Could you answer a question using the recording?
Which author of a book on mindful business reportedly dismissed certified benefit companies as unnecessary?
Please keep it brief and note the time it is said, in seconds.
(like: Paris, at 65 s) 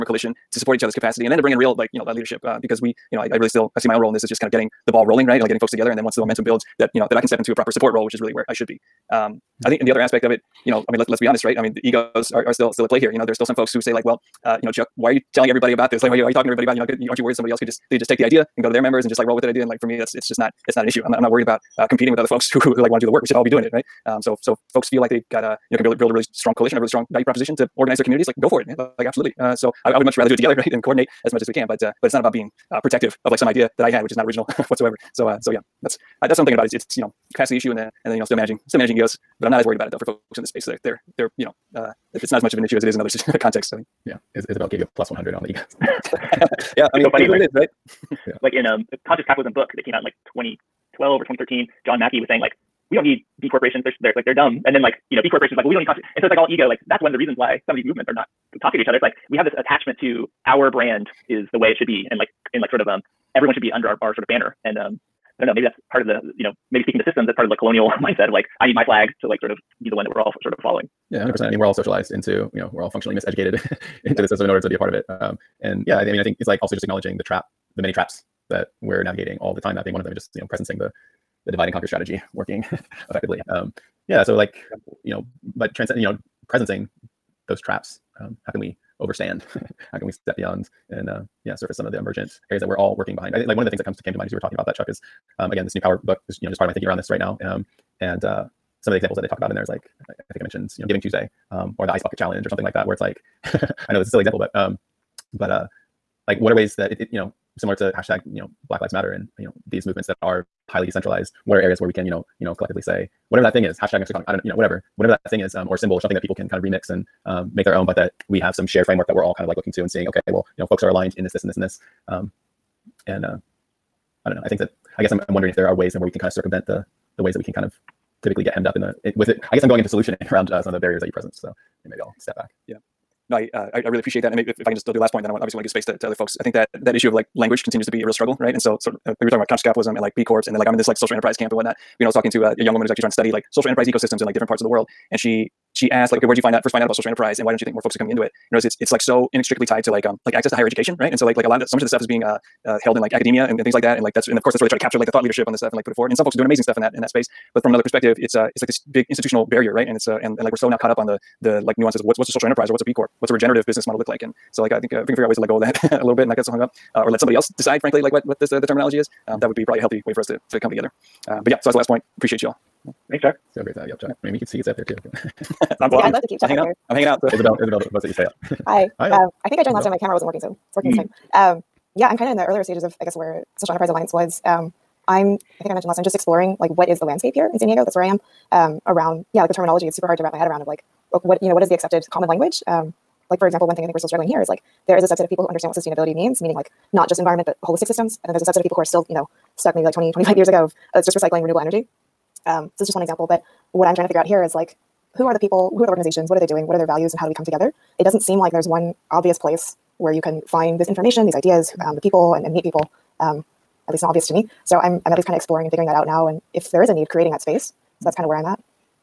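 John Mackey, at 51 s.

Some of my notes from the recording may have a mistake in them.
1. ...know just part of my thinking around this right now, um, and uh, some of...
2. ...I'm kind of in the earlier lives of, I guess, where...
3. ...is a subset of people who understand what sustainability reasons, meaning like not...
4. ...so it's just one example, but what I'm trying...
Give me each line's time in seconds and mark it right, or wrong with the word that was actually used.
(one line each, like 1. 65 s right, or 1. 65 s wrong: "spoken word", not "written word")
1. 96 s right
2. 182 s wrong: "stages", not "lives"
3. 194 s wrong: "means", not "reasons"
4. 202 s right.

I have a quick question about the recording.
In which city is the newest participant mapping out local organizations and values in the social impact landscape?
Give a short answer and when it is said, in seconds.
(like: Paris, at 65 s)
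San Diego, at 187 s.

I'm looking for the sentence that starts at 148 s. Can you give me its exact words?
You know, it's it's like so inextricably tied to like um, like access to higher education, right?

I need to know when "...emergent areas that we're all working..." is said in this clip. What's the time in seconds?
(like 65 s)
91 s.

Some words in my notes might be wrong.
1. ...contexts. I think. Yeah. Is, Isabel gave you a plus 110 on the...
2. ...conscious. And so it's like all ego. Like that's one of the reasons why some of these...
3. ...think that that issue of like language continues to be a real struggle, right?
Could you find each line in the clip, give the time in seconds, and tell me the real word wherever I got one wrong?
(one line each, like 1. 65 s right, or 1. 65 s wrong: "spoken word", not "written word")
1. 43 s wrong: "100", not "110"
2. 55 s right
3. 136 s right.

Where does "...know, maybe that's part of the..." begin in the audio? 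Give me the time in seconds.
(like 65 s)
65 s.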